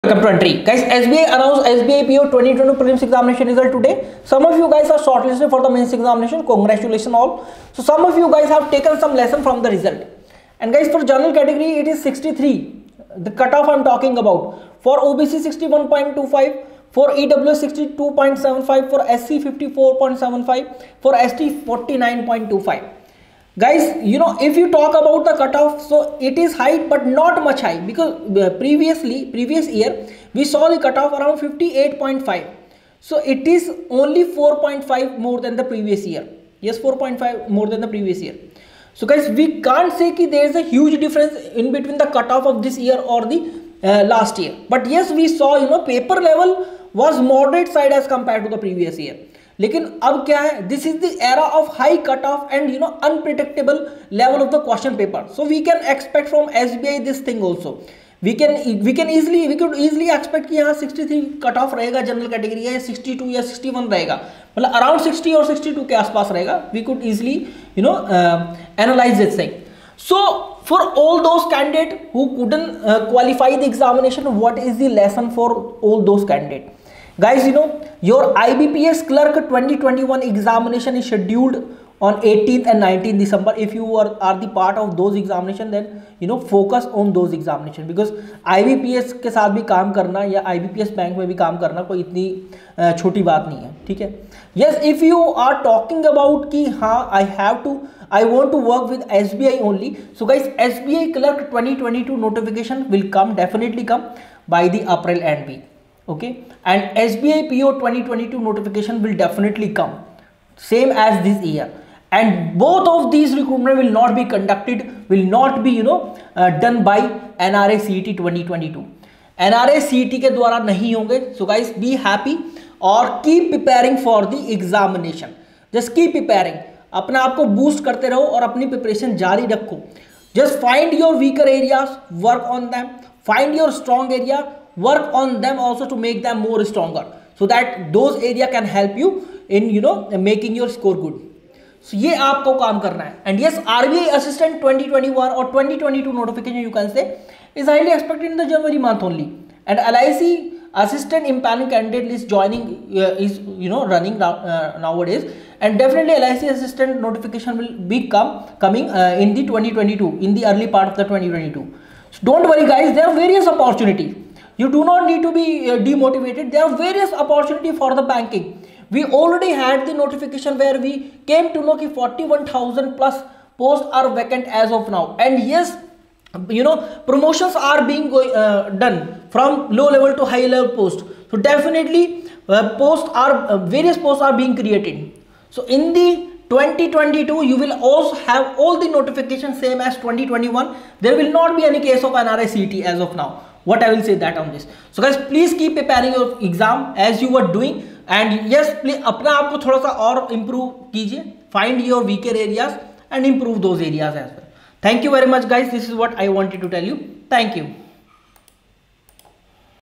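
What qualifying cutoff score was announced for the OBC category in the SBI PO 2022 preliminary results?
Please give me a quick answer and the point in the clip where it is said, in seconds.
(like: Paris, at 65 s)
61.25, at 14 s.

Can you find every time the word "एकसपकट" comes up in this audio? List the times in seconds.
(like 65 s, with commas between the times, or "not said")
55 s, 60 s.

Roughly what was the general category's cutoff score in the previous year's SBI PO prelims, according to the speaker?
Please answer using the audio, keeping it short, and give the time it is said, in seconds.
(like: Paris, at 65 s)
58.5, at 31 s.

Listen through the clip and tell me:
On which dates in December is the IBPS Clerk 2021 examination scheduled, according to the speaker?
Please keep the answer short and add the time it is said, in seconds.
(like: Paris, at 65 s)
18th and 19th December, at 82 s.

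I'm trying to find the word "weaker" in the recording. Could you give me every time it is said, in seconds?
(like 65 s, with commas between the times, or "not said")
131 s, 202 s.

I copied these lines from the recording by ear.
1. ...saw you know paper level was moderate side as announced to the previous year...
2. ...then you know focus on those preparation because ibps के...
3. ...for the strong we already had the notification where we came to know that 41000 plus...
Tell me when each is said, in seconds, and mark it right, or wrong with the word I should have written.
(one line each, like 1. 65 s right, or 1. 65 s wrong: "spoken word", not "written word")
1. 45 s wrong: "compared", not "announced"
2. 85 s wrong: "examination", not "preparation"
3. 167 s wrong: "banking", not "strong".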